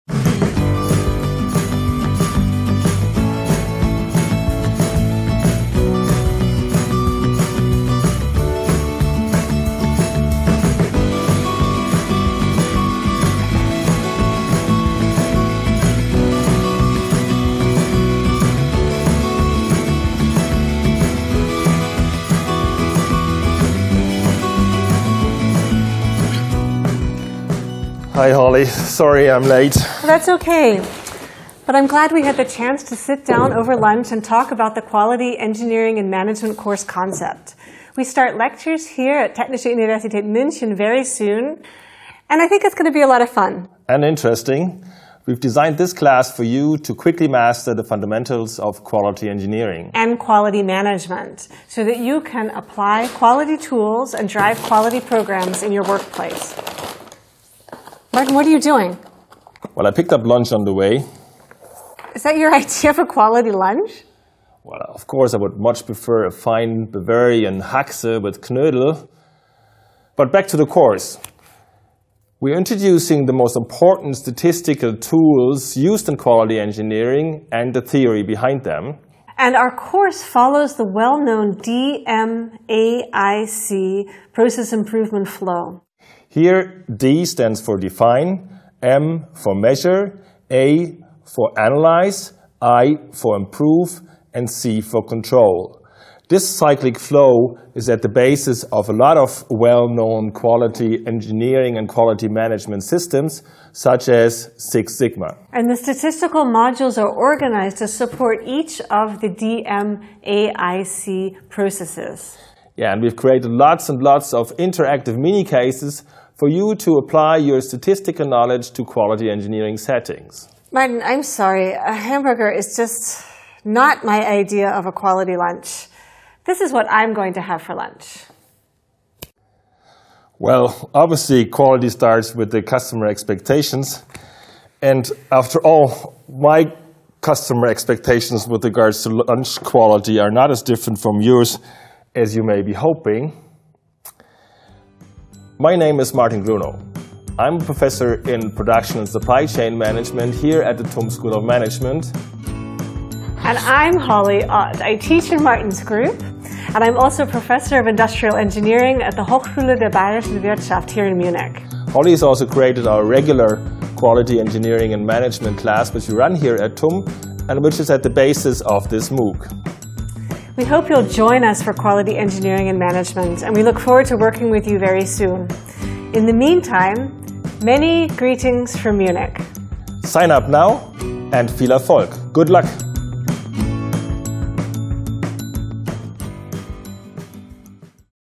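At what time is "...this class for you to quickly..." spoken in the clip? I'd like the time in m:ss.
0:45.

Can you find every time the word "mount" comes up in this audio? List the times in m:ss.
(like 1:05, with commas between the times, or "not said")
not said.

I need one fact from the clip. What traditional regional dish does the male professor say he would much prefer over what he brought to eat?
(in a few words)
Bavarian Haxe with Knödel.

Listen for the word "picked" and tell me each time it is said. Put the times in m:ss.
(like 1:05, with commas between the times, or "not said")
0:59.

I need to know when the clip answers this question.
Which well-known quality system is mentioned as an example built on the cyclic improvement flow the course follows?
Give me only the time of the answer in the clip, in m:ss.
1:44.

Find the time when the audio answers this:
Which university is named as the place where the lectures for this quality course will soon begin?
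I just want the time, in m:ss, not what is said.
0:39.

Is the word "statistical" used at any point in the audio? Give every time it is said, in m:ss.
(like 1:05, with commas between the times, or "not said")
1:14, 1:45, 1:57.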